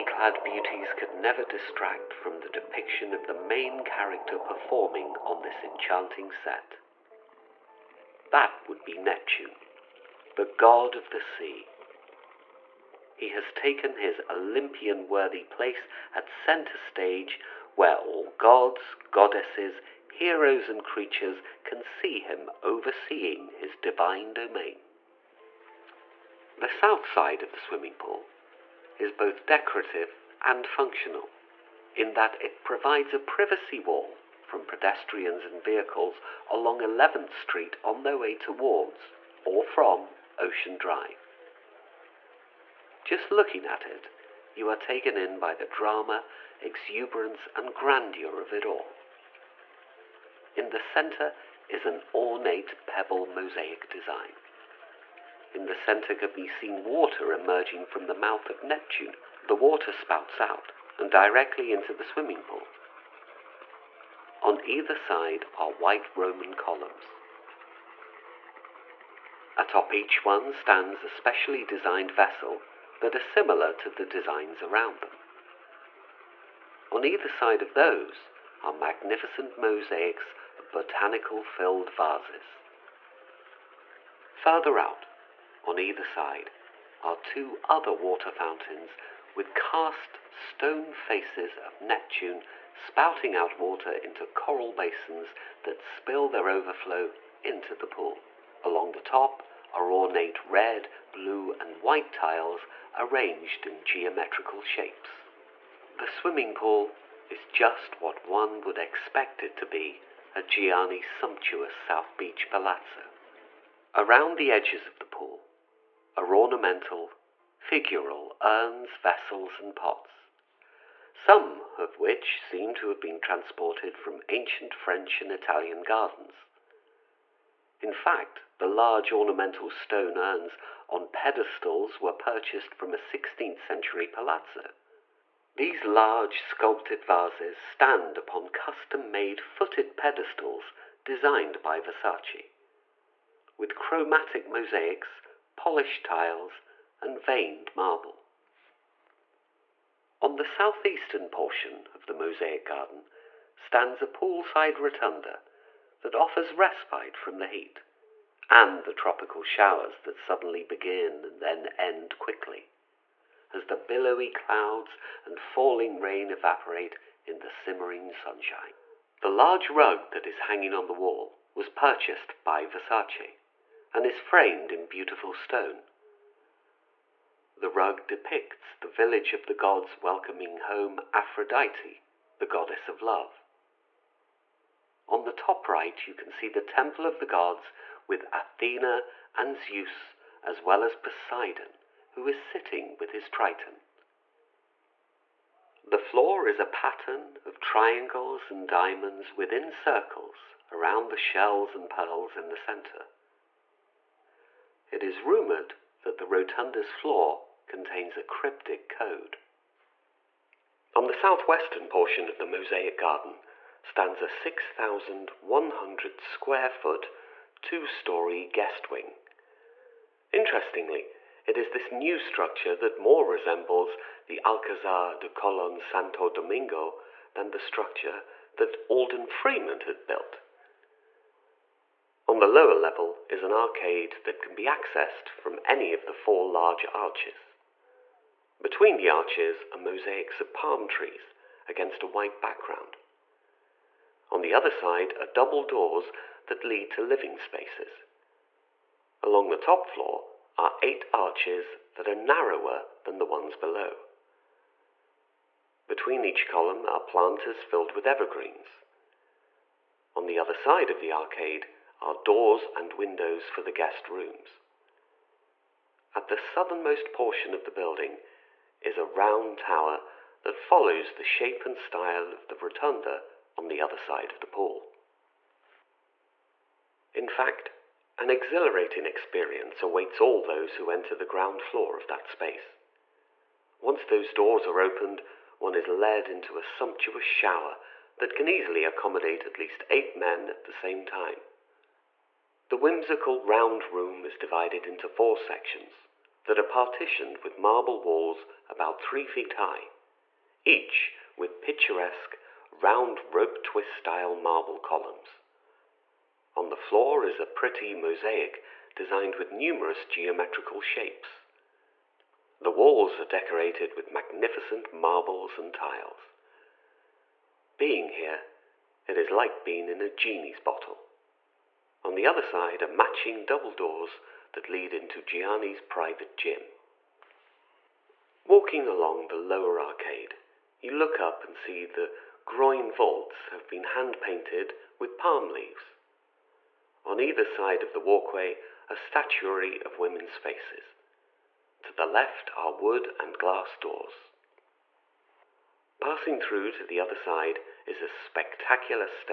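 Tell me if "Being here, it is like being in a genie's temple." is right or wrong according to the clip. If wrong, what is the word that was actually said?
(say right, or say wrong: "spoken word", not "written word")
wrong: "bottle", not "temple".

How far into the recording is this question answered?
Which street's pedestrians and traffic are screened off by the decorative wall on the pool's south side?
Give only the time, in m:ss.
0:36.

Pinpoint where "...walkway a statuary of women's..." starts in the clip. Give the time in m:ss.
5:37.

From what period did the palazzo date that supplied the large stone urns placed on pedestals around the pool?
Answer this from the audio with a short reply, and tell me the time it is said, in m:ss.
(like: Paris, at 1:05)
16th century, at 2:12.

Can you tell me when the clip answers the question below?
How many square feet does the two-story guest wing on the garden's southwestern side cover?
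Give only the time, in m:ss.
3:34.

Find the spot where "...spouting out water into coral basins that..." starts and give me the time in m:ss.
1:32.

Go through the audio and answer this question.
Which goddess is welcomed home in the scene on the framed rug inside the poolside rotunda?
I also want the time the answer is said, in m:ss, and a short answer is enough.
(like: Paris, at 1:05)
Aphrodite, at 3:01.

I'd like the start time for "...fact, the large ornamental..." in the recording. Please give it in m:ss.
2:07.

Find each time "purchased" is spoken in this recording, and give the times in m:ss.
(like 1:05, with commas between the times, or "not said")
2:12, 2:51.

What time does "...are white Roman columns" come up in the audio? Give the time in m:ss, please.
1:05.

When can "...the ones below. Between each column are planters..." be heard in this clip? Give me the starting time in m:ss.
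4:13.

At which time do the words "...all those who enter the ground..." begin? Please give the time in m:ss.
4:40.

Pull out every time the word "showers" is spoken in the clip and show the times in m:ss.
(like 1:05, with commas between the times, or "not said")
2:39, 4:47.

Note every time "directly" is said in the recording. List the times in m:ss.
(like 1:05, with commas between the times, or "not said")
1:01.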